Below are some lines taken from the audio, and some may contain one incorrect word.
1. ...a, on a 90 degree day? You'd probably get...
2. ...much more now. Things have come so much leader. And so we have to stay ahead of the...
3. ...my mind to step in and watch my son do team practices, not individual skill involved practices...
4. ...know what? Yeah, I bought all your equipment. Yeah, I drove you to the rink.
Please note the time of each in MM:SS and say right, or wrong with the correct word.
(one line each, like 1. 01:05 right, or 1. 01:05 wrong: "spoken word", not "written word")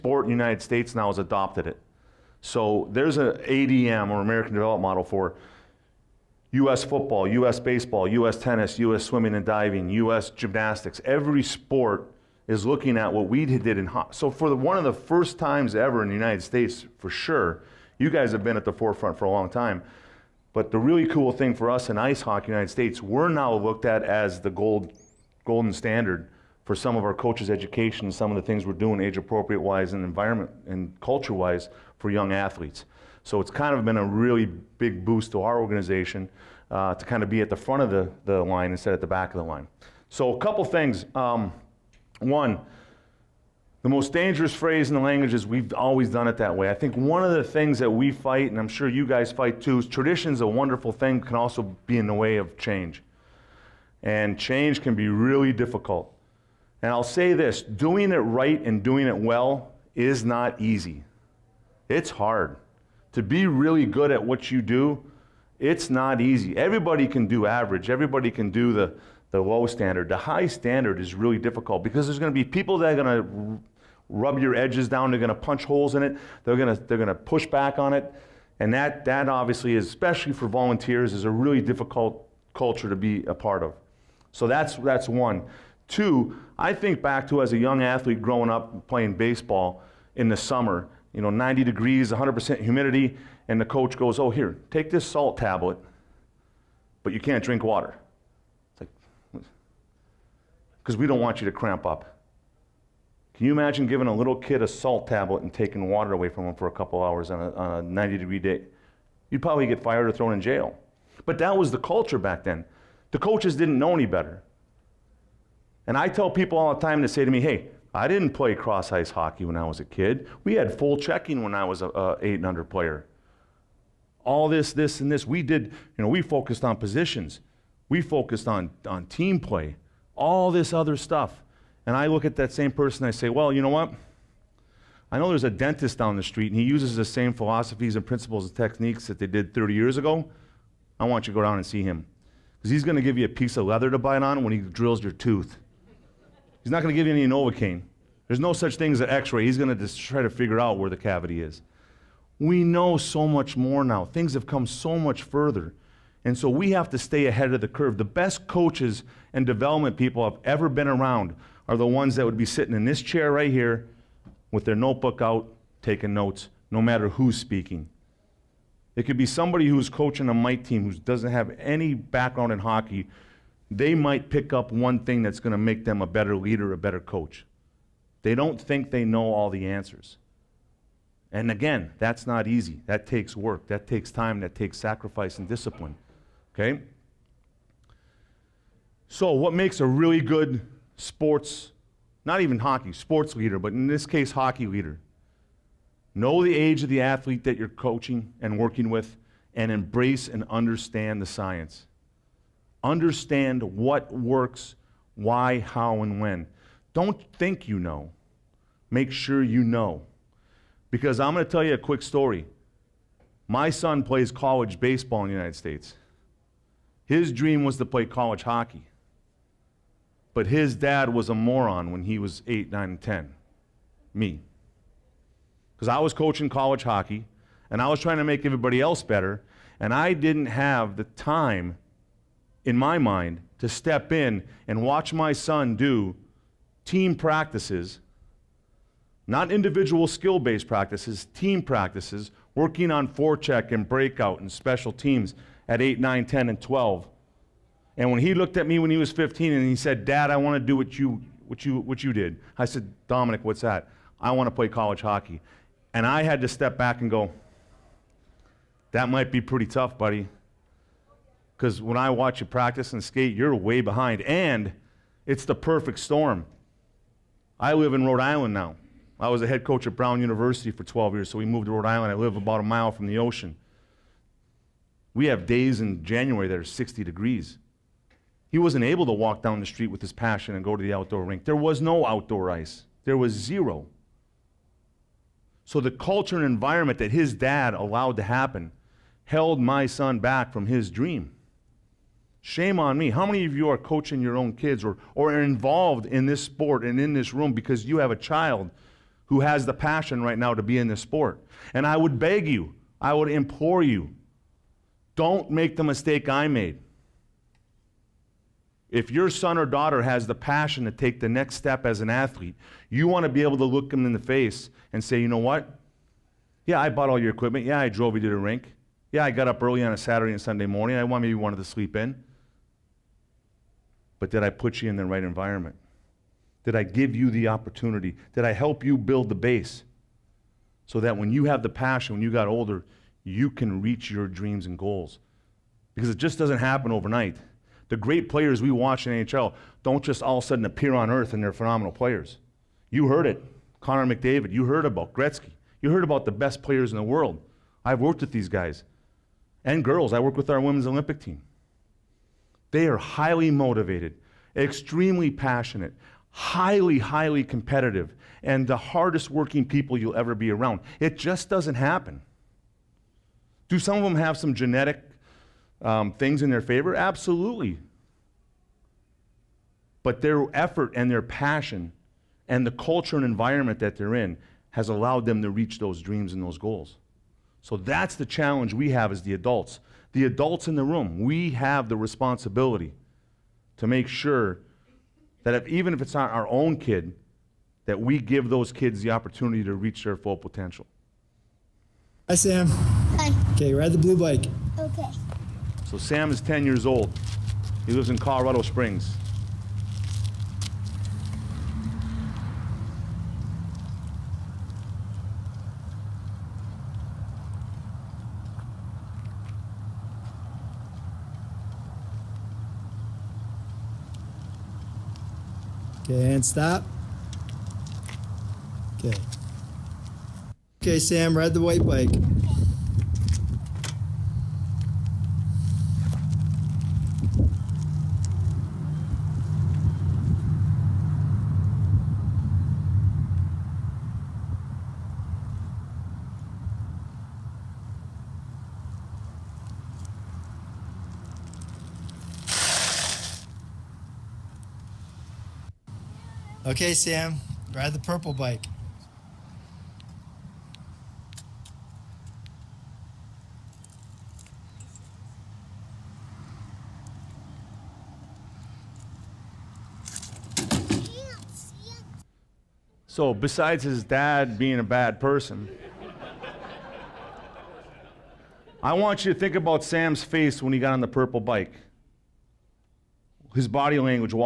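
1. 01:47 right
2. 02:33 wrong: "further", not "leader"
3. 03:52 wrong: "based", not "involved"
4. 05:15 right.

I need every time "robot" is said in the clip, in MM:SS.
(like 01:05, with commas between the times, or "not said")
not said.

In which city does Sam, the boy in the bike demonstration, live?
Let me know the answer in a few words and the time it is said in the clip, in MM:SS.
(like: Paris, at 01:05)
Colorado Springs, at 06:38.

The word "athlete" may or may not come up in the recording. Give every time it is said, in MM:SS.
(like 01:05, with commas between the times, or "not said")
00:32, 01:27, 03:17, 05:12.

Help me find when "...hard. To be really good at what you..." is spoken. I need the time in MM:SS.
01:02.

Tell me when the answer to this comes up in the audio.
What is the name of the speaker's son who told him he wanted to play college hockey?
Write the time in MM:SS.
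04:13.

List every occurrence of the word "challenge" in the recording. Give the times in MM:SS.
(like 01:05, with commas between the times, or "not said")
06:18.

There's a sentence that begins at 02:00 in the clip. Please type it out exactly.
We had full checking when I was a, a eight and under player.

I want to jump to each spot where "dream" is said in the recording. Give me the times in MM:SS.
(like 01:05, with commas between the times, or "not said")
03:37, 04:50, 05:34, 06:16.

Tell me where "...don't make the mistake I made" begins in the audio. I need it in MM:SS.
05:05.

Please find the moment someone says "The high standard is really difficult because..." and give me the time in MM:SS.
01:10.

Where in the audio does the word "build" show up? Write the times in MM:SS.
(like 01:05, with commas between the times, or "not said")
05:28.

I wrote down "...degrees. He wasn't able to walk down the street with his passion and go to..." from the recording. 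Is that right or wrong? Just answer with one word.
right.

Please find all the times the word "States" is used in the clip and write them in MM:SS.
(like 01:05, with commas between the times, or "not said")
00:00, 00:16, 00:22, 03:35.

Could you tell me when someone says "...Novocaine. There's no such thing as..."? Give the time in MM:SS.
02:27.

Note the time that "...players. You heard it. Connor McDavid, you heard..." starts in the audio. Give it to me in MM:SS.
05:41.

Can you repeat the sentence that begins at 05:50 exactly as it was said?
I work with our women's Olympic team.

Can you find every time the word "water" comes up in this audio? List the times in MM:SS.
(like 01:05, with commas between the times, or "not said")
01:37, 01:45.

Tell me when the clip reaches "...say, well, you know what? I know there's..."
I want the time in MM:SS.
02:13.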